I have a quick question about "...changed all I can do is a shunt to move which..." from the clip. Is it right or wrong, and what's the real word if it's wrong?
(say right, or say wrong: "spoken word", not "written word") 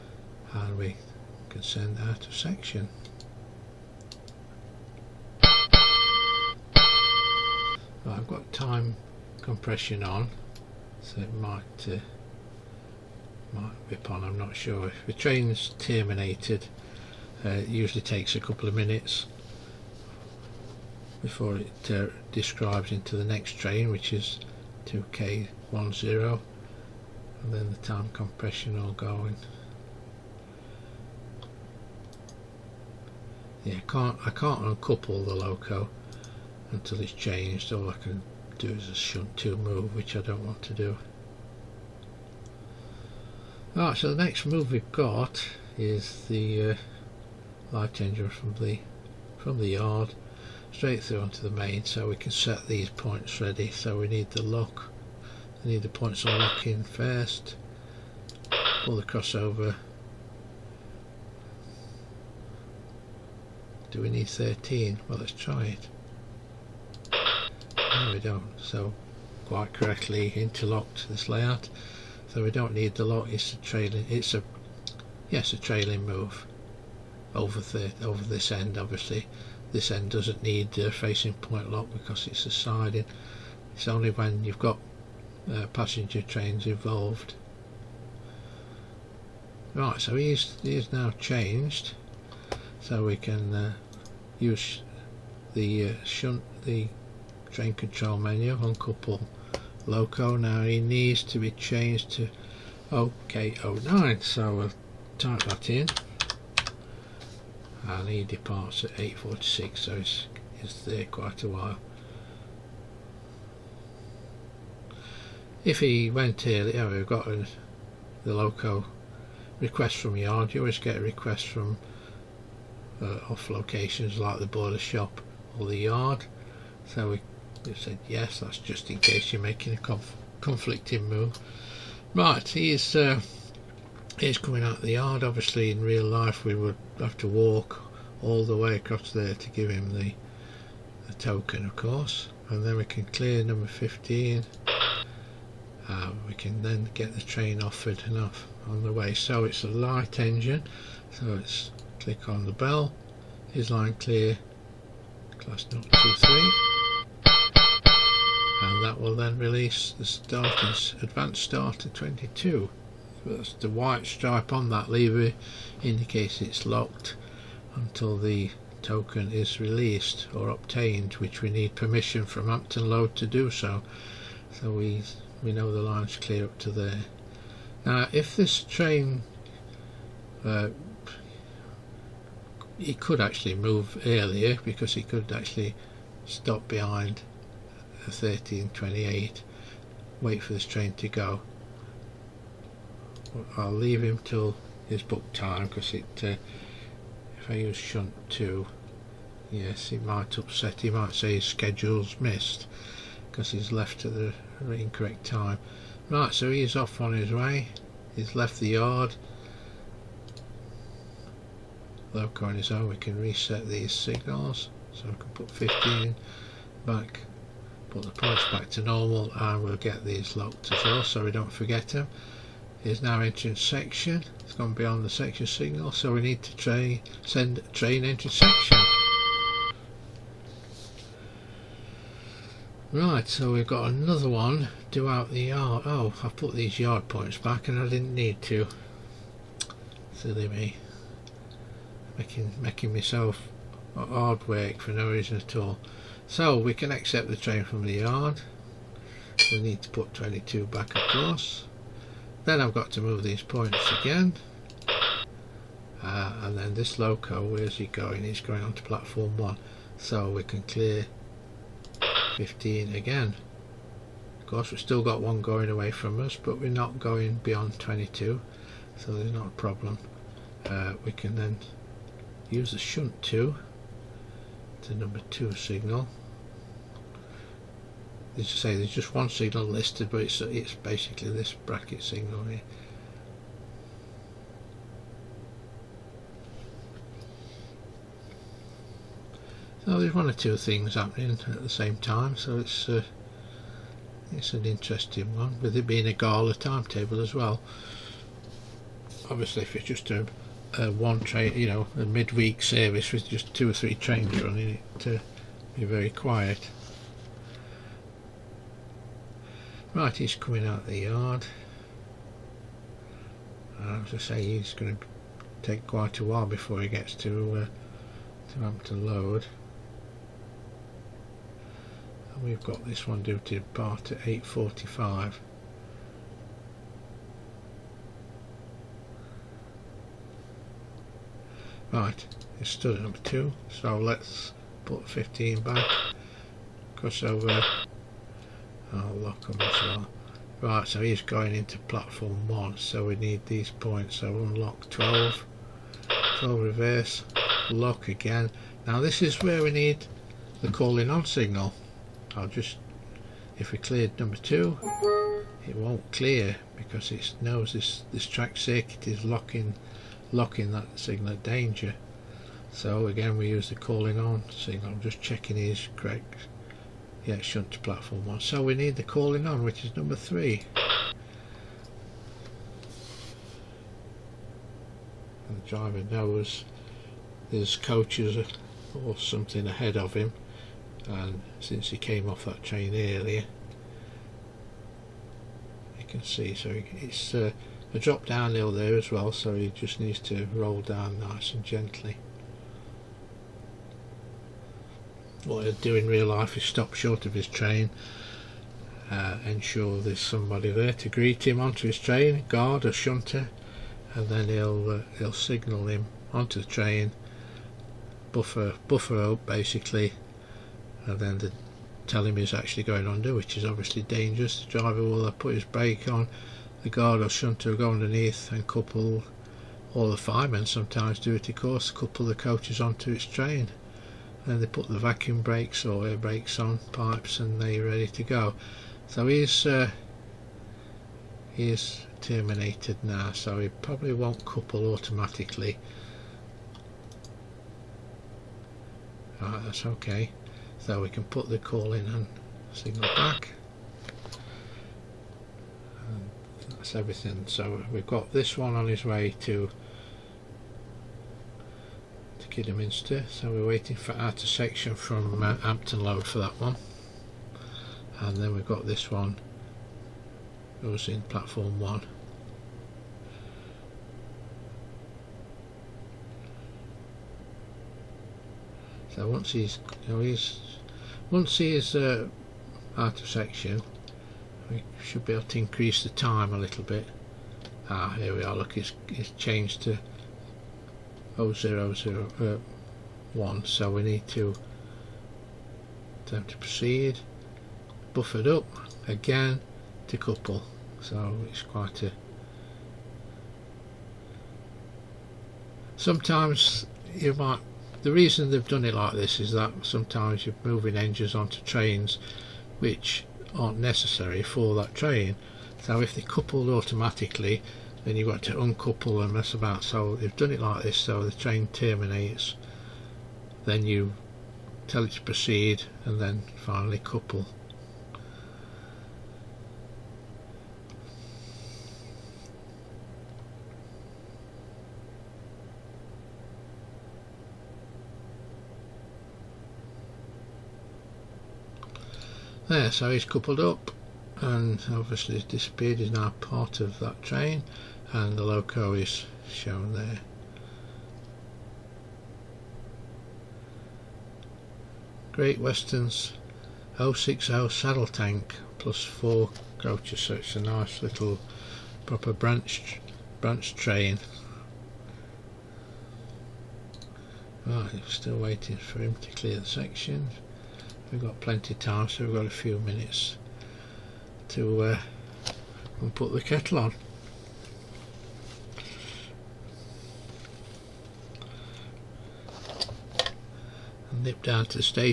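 right.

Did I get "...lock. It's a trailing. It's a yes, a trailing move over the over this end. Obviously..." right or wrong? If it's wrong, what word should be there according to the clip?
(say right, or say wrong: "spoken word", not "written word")
right.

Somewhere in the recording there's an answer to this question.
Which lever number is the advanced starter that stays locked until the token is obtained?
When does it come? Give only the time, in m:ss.
2:41.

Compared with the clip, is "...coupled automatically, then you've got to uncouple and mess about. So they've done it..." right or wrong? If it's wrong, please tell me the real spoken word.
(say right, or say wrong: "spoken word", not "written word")
right.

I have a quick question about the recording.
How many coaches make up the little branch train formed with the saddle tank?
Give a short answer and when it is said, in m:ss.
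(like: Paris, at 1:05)
4, at 9:09.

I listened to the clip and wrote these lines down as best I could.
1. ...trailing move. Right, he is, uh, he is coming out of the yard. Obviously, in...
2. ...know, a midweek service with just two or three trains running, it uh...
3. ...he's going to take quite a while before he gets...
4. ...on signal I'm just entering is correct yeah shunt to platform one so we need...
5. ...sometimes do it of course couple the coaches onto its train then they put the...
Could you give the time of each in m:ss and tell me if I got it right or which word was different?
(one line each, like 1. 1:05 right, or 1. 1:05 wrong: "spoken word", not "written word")
1. 2:10 wrong: "conflicting", not "trailing"
2. 5:01 right
3. 5:14 right
4. 6:04 wrong: "checking", not "entering"
5. 7:00 right.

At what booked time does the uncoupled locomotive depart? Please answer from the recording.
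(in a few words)
8:46.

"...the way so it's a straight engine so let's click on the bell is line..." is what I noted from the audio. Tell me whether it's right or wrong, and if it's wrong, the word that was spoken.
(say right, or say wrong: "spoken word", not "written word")
wrong: "light", not "straight".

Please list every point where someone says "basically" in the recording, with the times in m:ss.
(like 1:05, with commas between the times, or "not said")
4:40, 6:49.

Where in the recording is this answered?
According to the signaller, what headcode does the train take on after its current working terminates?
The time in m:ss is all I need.
0:24.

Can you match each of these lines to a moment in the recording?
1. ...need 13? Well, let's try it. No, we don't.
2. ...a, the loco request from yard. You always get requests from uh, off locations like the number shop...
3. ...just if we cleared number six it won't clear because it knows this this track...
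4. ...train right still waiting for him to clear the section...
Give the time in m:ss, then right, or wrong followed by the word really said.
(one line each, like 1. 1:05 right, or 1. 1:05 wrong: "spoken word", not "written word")
1. 1:04 right
2. 1:57 wrong: "boiler", not "number"
3. 5:52 wrong: "two", not "six"
4. 9:13 right.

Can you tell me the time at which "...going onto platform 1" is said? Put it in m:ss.
4:18.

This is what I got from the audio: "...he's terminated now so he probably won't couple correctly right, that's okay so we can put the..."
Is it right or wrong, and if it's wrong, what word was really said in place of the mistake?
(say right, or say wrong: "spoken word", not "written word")
wrong: "automatically", not "correctly".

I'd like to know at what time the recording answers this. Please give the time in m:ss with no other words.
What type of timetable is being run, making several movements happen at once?
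4:56.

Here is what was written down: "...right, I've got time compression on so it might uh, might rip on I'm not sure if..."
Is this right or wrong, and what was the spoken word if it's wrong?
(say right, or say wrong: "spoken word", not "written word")
right.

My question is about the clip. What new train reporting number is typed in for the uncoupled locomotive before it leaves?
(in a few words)
OK09.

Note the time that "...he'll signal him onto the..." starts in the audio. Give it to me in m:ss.
6:45.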